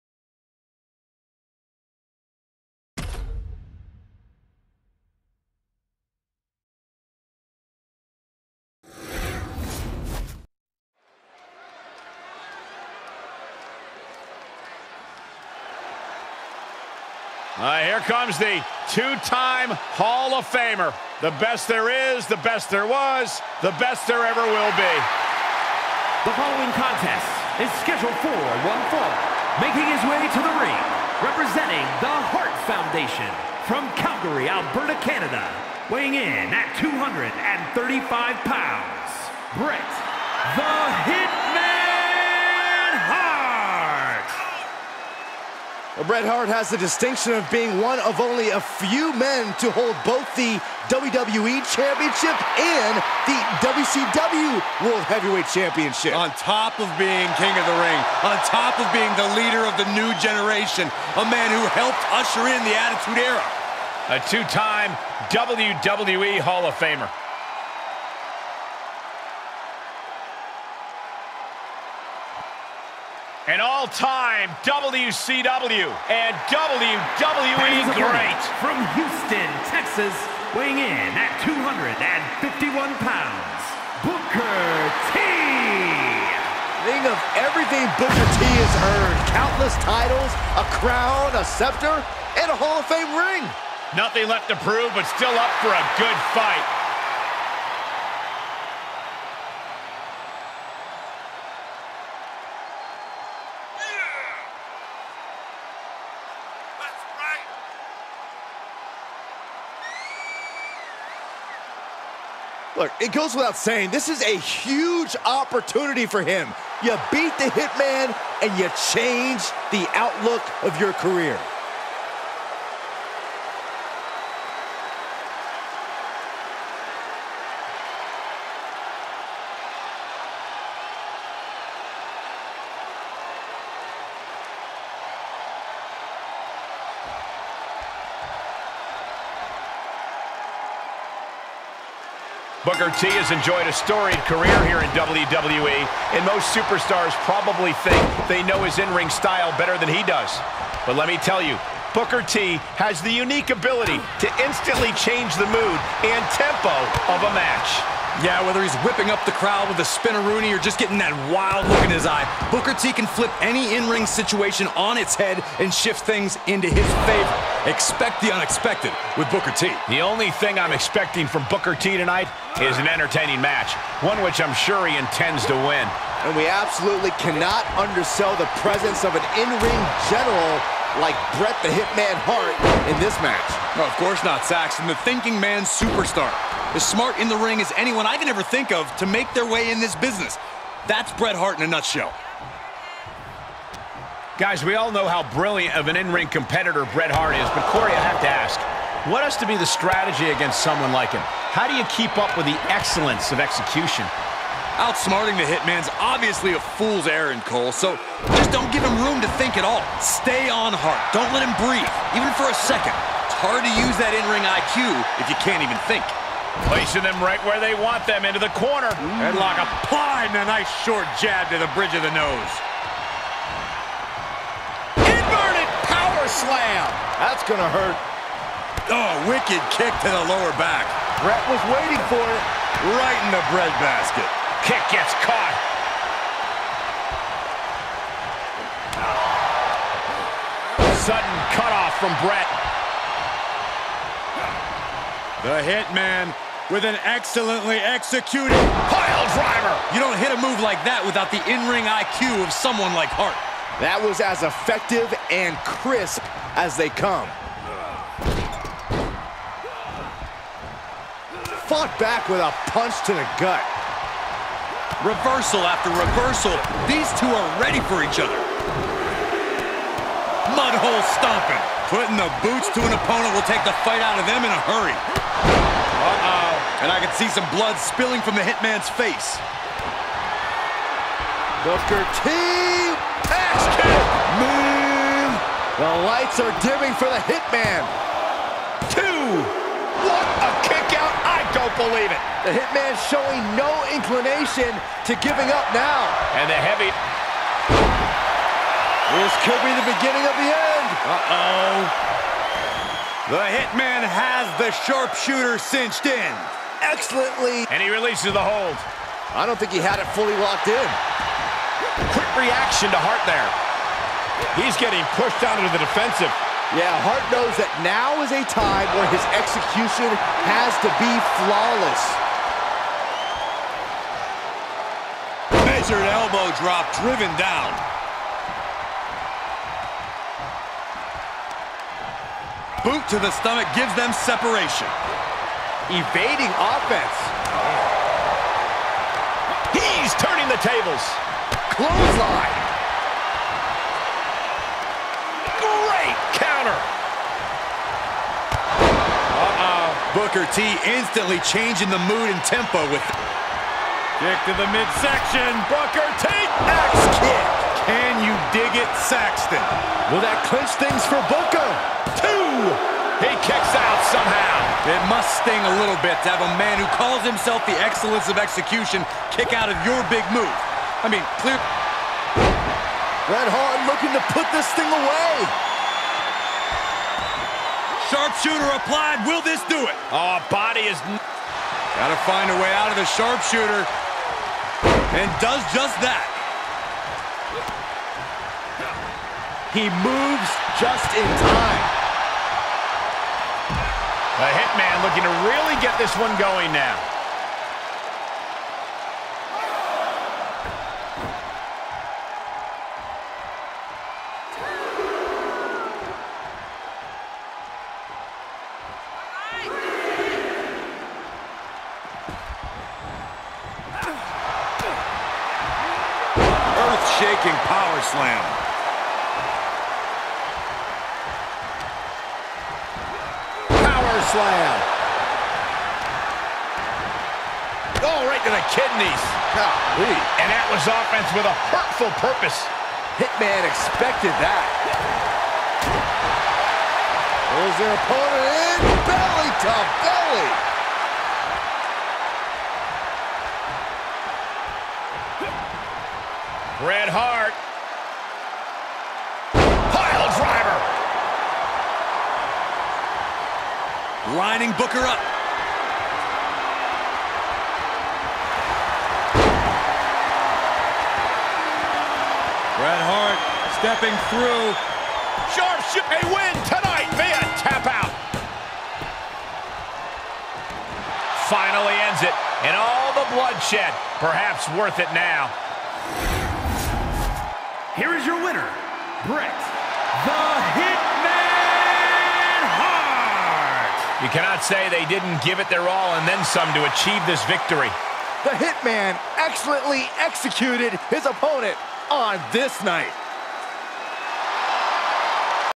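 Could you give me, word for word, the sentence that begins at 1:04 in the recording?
A two-time WWE Hall of Famer.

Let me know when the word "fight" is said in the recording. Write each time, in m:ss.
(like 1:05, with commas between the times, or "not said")
1:36, 4:33.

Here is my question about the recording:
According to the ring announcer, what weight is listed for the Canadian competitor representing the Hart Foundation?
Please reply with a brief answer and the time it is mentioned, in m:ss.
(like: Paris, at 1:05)
235 pounds, at 0:36.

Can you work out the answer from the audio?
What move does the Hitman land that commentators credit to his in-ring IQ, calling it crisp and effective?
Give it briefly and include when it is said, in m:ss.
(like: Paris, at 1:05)
Pile driver, at 4:08.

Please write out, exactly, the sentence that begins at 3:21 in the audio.
How do you keep up with the excellence of execution?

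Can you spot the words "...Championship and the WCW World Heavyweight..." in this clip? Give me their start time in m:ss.
0:51.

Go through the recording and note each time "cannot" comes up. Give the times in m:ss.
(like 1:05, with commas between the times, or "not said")
2:57, 8:04.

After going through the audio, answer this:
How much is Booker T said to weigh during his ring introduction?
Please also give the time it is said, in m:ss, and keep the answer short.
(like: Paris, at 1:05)
251 pounds, at 1:21.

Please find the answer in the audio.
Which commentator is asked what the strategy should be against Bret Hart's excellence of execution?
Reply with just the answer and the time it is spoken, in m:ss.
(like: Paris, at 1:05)
Corey, at 3:17.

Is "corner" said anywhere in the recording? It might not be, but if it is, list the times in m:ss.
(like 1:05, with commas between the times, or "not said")
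3:38.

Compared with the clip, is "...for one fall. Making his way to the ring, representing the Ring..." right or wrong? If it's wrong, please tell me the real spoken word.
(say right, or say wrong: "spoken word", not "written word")
wrong: "Hart", not "Ring".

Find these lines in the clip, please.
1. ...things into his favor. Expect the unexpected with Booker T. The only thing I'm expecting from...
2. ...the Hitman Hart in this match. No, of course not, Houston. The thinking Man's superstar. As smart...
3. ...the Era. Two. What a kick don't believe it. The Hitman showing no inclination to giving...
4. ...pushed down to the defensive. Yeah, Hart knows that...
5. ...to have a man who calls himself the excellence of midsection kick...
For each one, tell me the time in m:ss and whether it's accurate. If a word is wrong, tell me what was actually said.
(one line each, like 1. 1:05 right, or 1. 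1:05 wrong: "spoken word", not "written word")
1. 2:46 right
2. 3:01 wrong: "Saxton", not "Houston"
3. 4:47 wrong: "Hitman", not "Era"
4. 5:15 right
5. 6:06 wrong: "execution", not "midsection".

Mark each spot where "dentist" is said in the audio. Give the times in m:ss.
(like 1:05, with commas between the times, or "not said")
not said.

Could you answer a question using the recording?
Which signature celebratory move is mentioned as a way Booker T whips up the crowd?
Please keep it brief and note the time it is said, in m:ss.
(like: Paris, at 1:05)
Spinneroonie, at 2:39.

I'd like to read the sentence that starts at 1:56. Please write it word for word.
You beat the Hitman, and you change the outlook of your career.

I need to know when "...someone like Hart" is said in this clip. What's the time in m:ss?
4:12.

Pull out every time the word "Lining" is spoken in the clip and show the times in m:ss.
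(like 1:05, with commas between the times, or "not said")
7:34.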